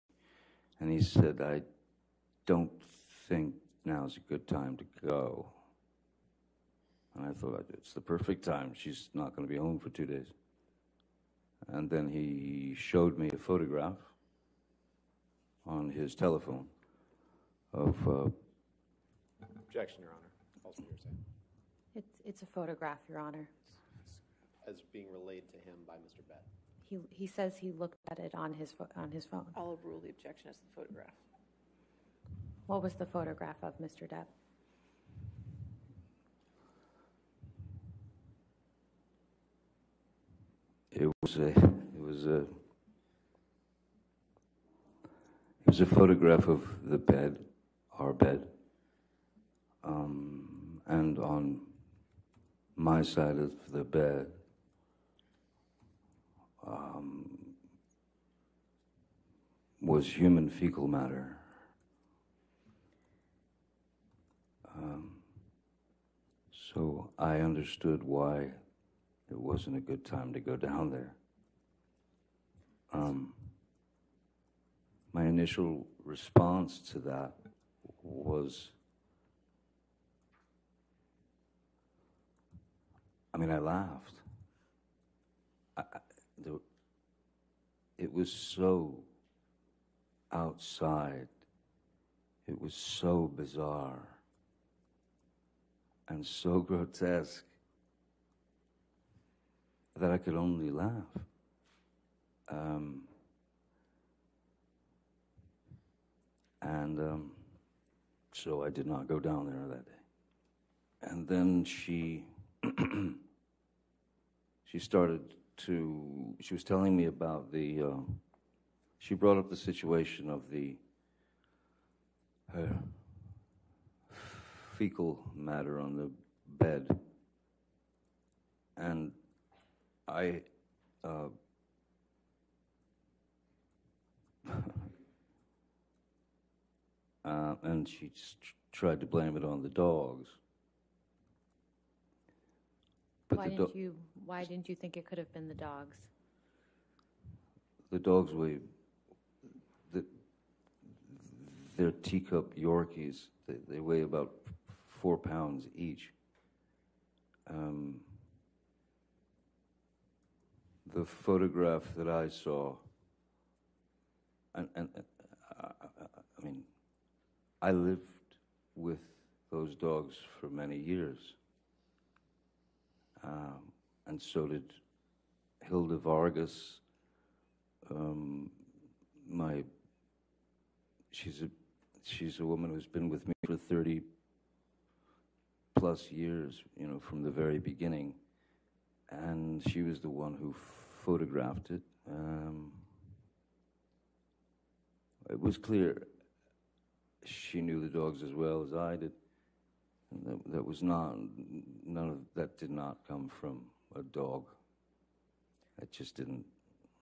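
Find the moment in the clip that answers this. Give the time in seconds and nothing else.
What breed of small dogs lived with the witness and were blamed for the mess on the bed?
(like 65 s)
151 s.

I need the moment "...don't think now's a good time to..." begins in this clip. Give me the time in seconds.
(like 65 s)
2 s.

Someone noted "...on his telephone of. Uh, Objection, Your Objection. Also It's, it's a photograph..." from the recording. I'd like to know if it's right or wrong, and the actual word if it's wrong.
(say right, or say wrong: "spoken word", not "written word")
wrong: "Honor", not "Objection".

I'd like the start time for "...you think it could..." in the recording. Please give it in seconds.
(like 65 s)
144 s.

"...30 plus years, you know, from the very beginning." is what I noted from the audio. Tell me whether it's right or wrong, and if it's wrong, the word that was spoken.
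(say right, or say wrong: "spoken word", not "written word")
right.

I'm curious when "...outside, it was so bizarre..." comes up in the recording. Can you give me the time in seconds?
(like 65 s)
90 s.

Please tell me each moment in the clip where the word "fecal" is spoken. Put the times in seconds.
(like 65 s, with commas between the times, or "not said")
60 s, 124 s.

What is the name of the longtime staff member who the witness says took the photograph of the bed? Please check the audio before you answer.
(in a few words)
Hilda Vargas.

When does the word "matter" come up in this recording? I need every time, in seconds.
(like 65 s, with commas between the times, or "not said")
60 s, 125 s.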